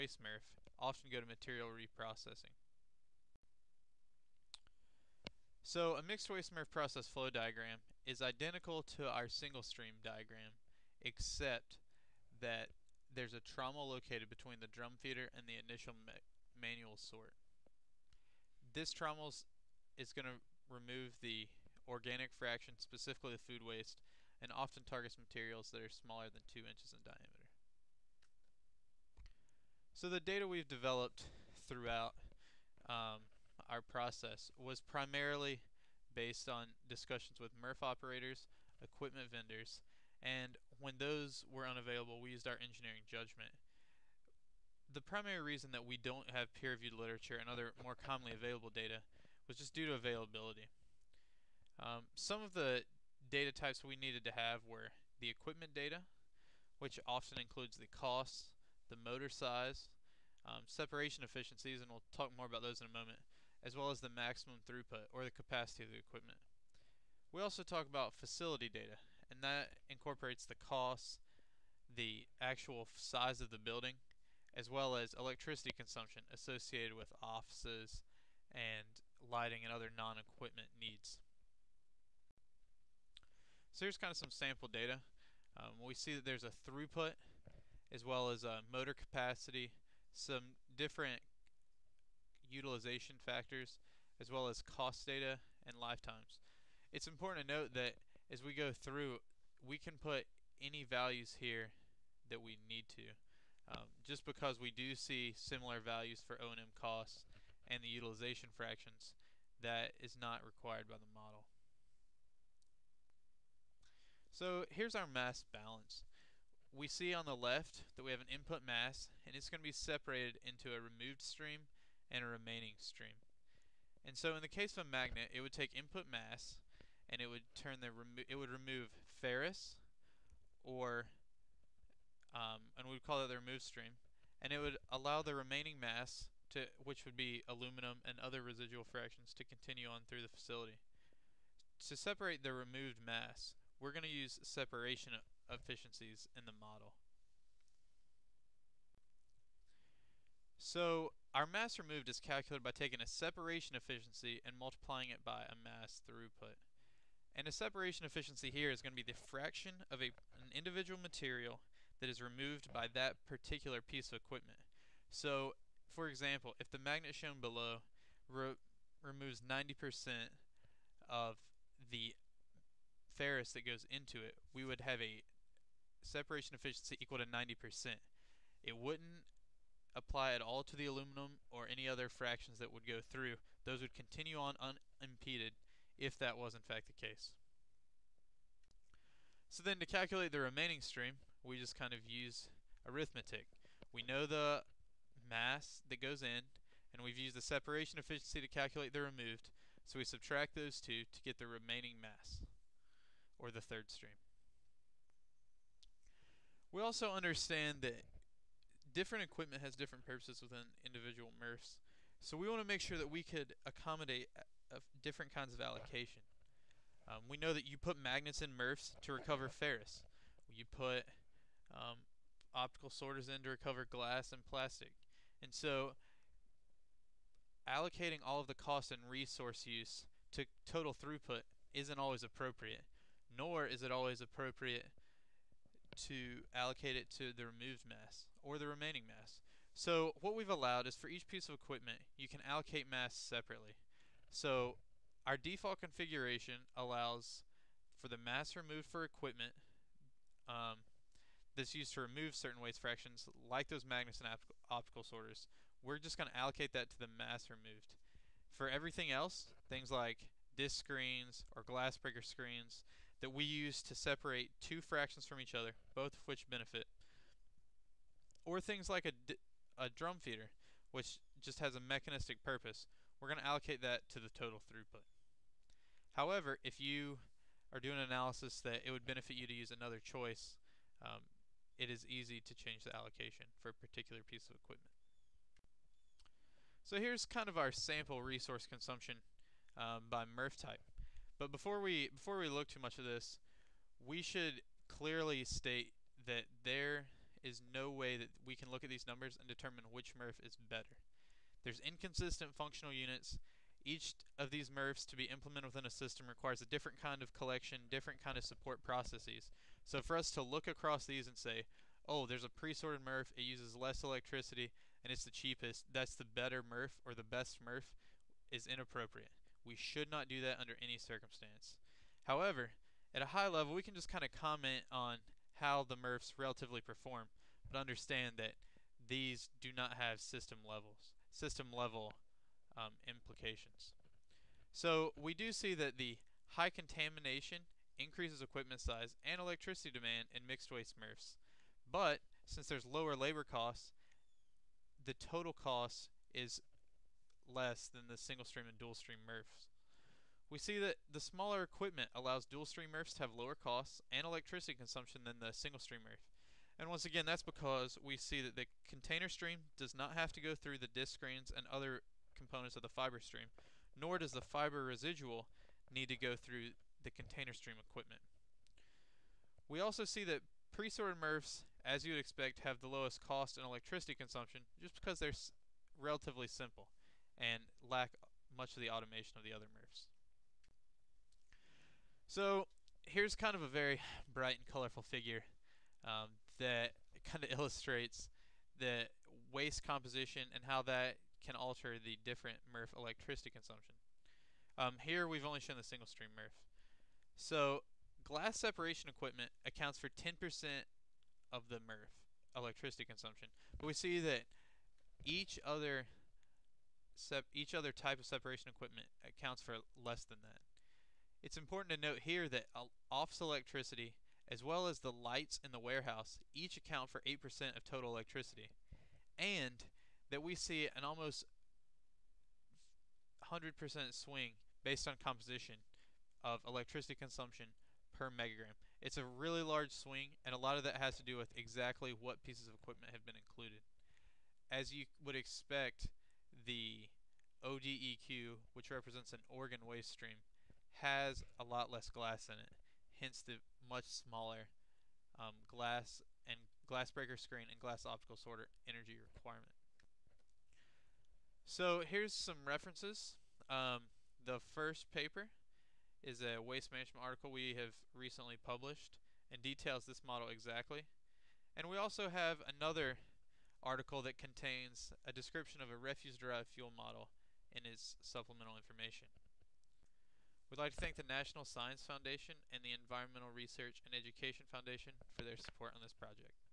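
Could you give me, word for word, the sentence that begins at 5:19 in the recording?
We should not do that under any circumstance.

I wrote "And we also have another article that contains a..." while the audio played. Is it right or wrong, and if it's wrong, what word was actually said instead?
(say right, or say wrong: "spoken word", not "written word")
right.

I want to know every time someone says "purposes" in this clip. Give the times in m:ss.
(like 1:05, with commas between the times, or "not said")
3:30, 4:32.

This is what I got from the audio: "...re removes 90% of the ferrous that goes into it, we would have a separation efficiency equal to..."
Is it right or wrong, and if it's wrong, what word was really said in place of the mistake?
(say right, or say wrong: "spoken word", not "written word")
right.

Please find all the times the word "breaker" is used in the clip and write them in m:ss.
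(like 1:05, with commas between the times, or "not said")
4:21, 7:27.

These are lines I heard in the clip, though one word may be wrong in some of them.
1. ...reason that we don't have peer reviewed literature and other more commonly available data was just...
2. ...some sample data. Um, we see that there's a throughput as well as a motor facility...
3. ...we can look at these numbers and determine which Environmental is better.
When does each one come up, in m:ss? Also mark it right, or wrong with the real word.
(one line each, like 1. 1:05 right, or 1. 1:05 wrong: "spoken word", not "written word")
1. 0:45 right
2. 1:24 wrong: "capacity", not "facility"
3. 4:58 wrong: "MRF", not "Environmental".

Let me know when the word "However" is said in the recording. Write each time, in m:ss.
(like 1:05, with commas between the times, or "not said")
4:36, 5:22.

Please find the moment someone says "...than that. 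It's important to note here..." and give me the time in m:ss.
6:50.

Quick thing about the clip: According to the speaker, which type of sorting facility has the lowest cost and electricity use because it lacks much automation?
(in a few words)
pre-sorted MRFs.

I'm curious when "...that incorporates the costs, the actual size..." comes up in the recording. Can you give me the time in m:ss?
1:09.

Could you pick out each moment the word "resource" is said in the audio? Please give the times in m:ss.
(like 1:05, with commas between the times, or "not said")
3:49, 4:48.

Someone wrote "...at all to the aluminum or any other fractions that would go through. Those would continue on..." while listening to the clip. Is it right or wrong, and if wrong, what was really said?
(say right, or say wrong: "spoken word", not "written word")
right.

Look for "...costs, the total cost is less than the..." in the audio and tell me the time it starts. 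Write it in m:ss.
5:43.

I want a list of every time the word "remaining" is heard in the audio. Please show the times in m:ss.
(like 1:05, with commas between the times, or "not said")
2:02, 2:15, 3:10, 3:21, 3:58.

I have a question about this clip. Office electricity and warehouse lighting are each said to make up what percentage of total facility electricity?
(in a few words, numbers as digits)
8%.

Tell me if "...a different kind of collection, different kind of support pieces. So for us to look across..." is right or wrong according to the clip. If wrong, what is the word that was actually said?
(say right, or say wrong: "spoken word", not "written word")
wrong: "processes", not "pieces".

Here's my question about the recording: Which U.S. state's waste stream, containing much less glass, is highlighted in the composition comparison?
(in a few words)
Oregon.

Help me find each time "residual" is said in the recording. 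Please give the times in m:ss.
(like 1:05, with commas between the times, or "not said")
2:18, 6:04.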